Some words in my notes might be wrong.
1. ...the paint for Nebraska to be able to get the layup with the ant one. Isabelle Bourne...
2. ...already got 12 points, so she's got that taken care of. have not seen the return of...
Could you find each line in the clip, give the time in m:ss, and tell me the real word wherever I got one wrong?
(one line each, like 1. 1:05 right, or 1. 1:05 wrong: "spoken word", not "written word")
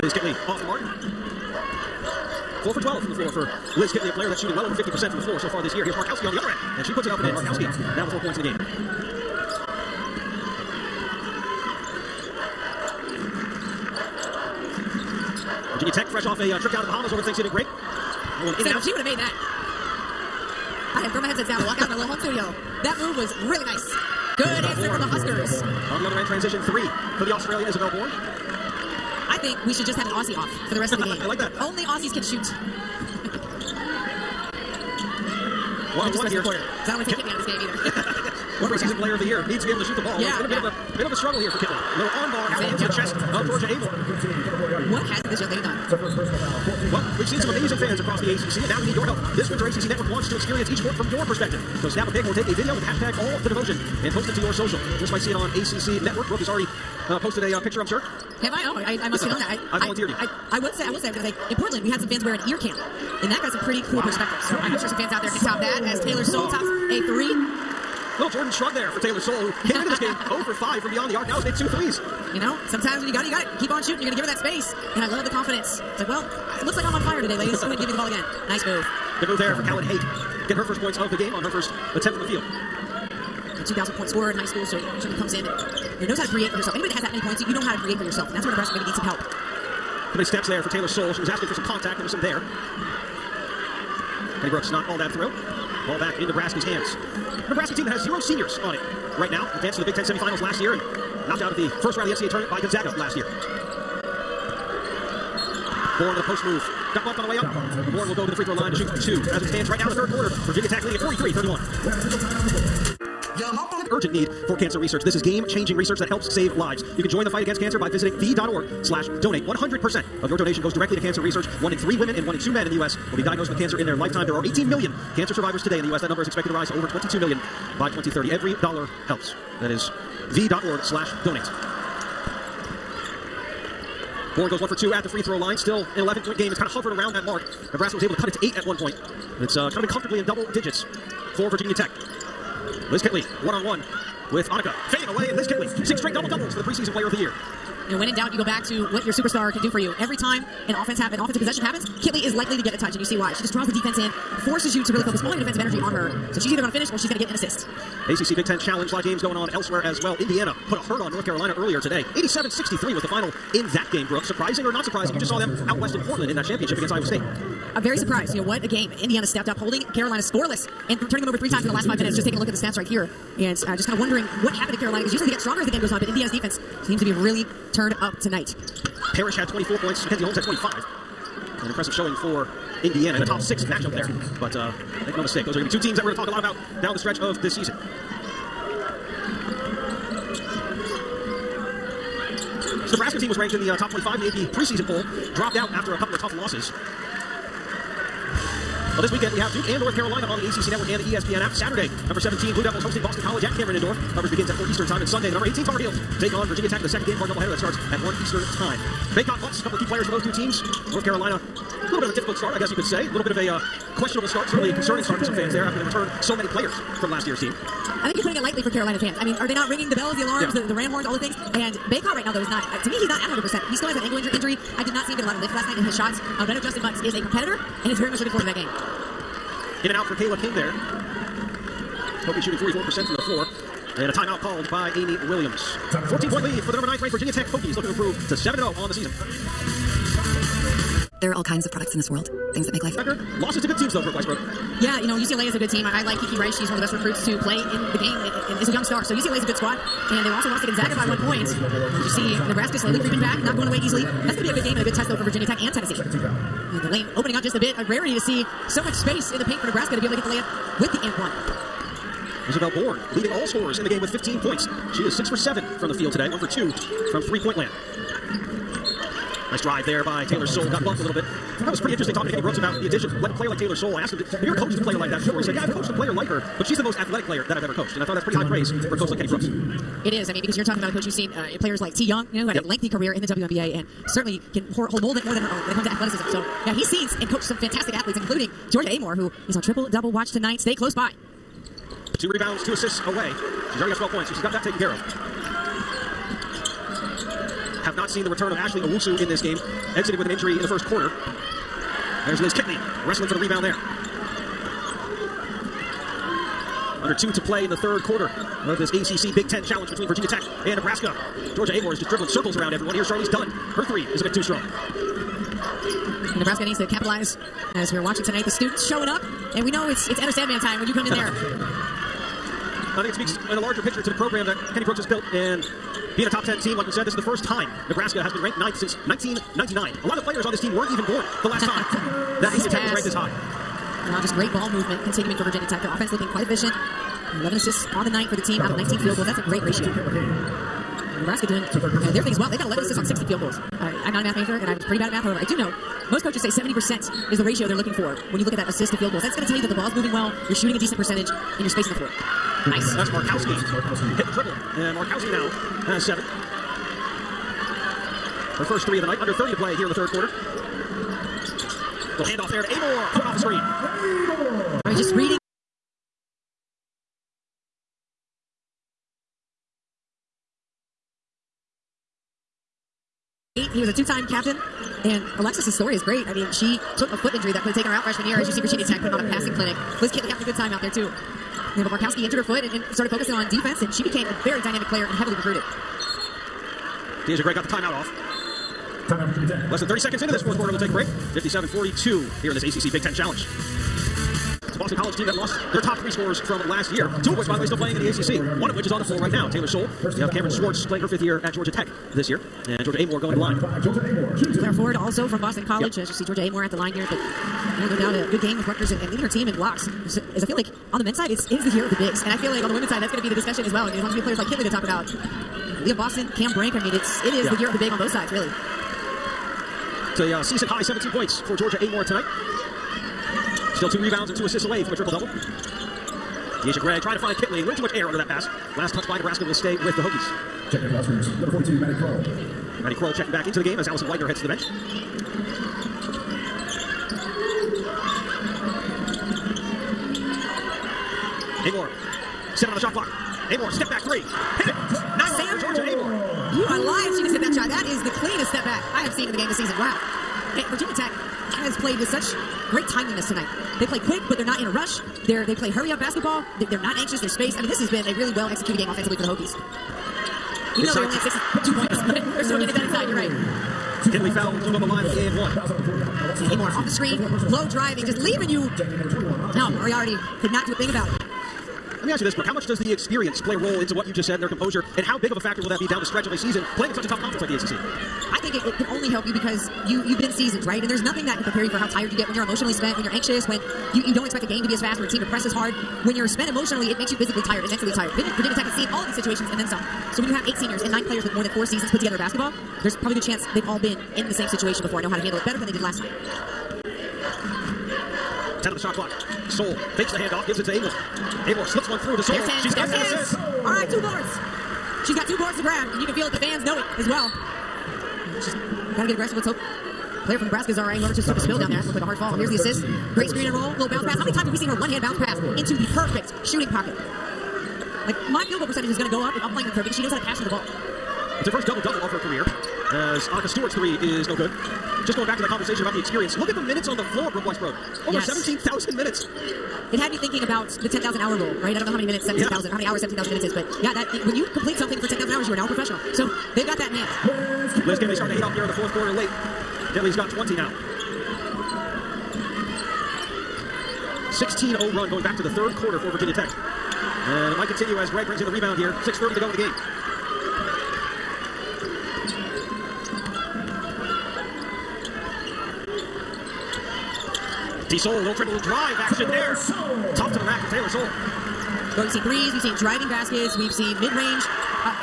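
1. 4:19 right
2. 4:53 right.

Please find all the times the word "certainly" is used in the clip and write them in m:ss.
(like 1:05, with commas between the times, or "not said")
1:25, 3:34, 4:44.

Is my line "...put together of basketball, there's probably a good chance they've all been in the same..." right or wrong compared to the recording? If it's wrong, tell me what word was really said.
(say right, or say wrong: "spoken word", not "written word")
right.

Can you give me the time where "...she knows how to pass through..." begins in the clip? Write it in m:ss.
8:39.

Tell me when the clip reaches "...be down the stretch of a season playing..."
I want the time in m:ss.
7:55.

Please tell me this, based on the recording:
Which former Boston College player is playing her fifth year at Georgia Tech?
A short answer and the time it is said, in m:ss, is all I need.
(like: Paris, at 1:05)
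Cameron Swartz, at 6:40.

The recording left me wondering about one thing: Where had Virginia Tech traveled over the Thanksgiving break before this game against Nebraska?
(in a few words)
the Bahamas.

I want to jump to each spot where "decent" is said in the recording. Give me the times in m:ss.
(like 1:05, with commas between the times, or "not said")
5:50.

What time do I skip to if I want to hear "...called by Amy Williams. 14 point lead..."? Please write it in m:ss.
3:54.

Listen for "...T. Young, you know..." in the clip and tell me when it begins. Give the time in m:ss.
4:41.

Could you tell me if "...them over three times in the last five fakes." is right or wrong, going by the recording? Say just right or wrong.
wrong.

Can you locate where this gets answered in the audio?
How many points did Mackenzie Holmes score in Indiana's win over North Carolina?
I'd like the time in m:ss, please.
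3:00.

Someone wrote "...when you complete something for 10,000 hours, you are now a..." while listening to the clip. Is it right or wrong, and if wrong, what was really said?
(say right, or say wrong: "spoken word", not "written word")
right.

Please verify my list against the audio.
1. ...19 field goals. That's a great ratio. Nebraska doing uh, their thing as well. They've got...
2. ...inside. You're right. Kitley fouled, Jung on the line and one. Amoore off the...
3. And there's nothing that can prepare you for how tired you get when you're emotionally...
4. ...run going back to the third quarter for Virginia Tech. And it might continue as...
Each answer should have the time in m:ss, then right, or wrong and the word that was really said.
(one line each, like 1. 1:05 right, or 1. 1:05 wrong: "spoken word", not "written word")
1. 5:38 right
2. 7:42 right
3. 8:00 right
4. 9:04 right.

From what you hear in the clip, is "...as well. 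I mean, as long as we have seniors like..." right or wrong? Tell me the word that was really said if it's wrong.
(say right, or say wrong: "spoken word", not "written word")
wrong: "players", not "seniors".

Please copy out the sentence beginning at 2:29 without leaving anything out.
Every time an offense ha- an offensive possession happens, Kitley is likely to get a touch, and you see why.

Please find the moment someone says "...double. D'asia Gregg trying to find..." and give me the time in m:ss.
7:05.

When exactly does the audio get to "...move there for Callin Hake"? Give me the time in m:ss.
1:19.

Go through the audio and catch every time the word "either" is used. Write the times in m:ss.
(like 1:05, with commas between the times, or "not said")
0:37, 2:36.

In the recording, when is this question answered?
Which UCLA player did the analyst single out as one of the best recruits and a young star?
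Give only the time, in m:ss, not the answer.
4:06.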